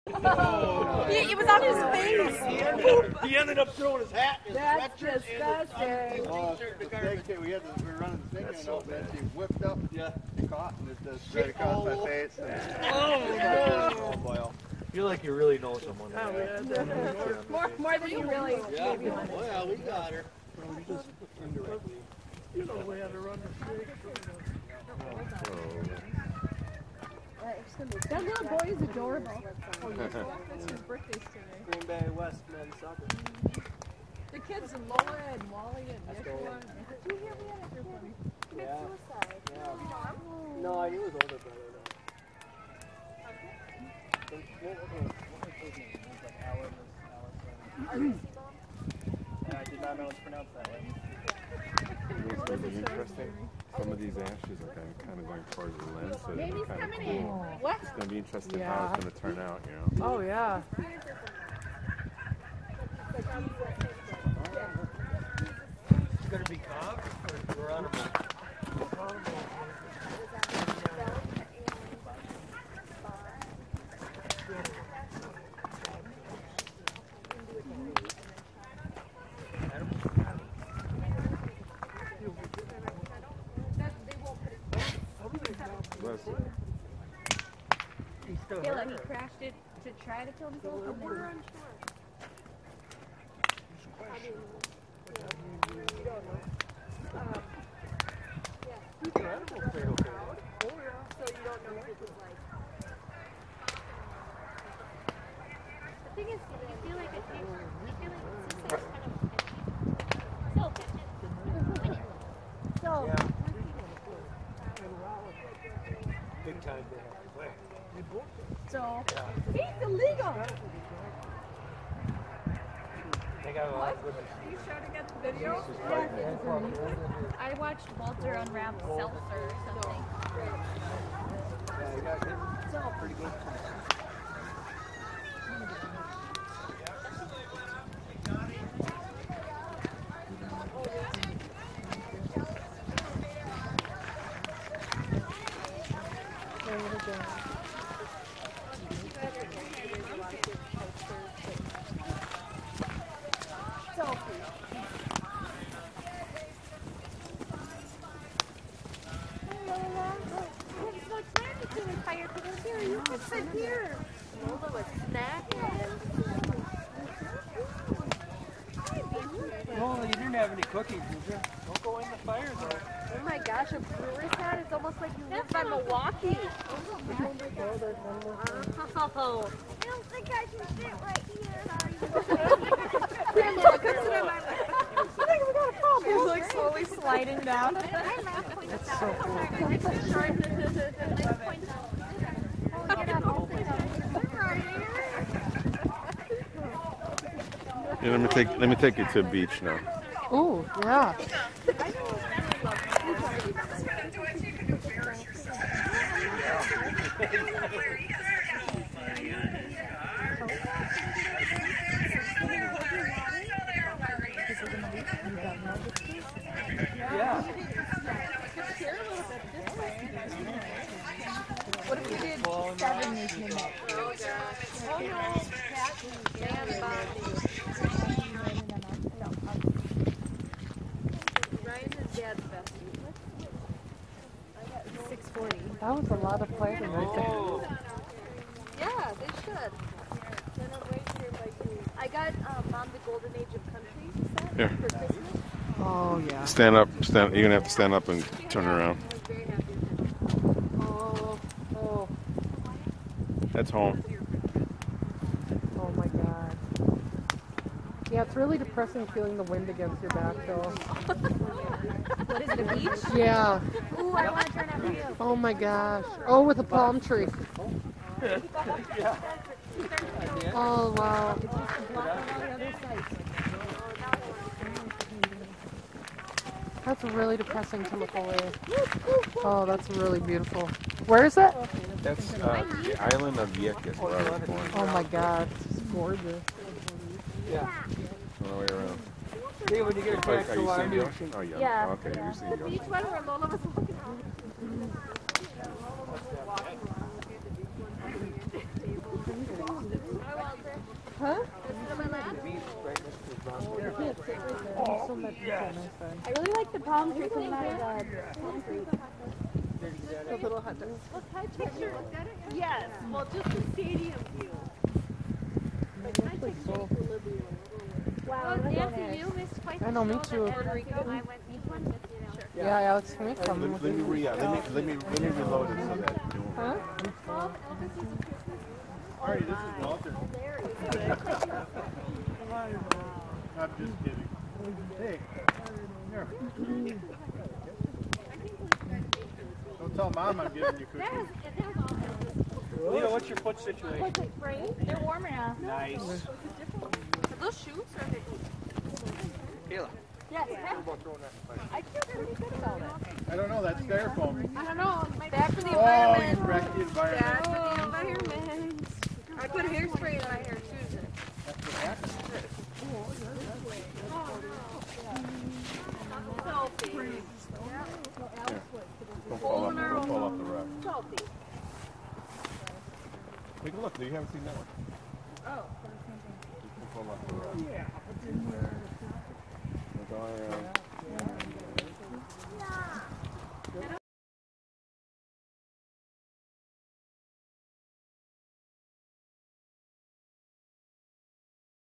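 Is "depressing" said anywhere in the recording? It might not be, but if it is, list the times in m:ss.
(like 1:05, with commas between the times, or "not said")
4:18, 4:37.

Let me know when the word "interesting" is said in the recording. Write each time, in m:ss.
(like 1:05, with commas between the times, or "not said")
0:52, 0:58.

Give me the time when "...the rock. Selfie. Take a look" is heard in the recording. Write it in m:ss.
6:10.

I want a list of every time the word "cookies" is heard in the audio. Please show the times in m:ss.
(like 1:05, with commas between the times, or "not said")
2:50, 5:40.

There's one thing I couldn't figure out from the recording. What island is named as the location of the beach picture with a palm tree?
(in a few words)
Vieques.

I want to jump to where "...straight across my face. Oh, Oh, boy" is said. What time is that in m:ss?
0:11.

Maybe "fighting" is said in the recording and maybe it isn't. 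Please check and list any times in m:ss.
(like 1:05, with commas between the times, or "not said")
3:56.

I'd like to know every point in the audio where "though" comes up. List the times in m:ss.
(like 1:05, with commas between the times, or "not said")
0:41, 2:52, 4:20.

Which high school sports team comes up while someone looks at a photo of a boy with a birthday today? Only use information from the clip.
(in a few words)
Green Bay West men's soccer.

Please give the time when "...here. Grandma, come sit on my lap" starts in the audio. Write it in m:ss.
3:01.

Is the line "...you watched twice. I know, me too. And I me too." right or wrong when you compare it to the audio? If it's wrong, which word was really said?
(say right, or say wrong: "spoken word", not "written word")
wrong: "missed", not "watched".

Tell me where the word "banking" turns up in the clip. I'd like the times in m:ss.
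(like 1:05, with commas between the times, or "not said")
not said.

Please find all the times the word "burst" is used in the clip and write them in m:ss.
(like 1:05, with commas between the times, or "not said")
not said.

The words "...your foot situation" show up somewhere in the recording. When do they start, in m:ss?
5:43.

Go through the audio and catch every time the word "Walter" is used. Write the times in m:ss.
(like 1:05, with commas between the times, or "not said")
2:07, 5:29.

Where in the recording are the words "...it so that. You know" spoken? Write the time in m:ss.
5:25.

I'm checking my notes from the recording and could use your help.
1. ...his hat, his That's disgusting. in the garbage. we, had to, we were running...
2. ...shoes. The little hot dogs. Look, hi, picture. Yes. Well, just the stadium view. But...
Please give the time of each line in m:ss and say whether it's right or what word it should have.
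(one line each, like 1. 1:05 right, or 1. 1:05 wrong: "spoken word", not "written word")
1. 0:04 right
2. 5:08 wrong: "trees", not "shoes".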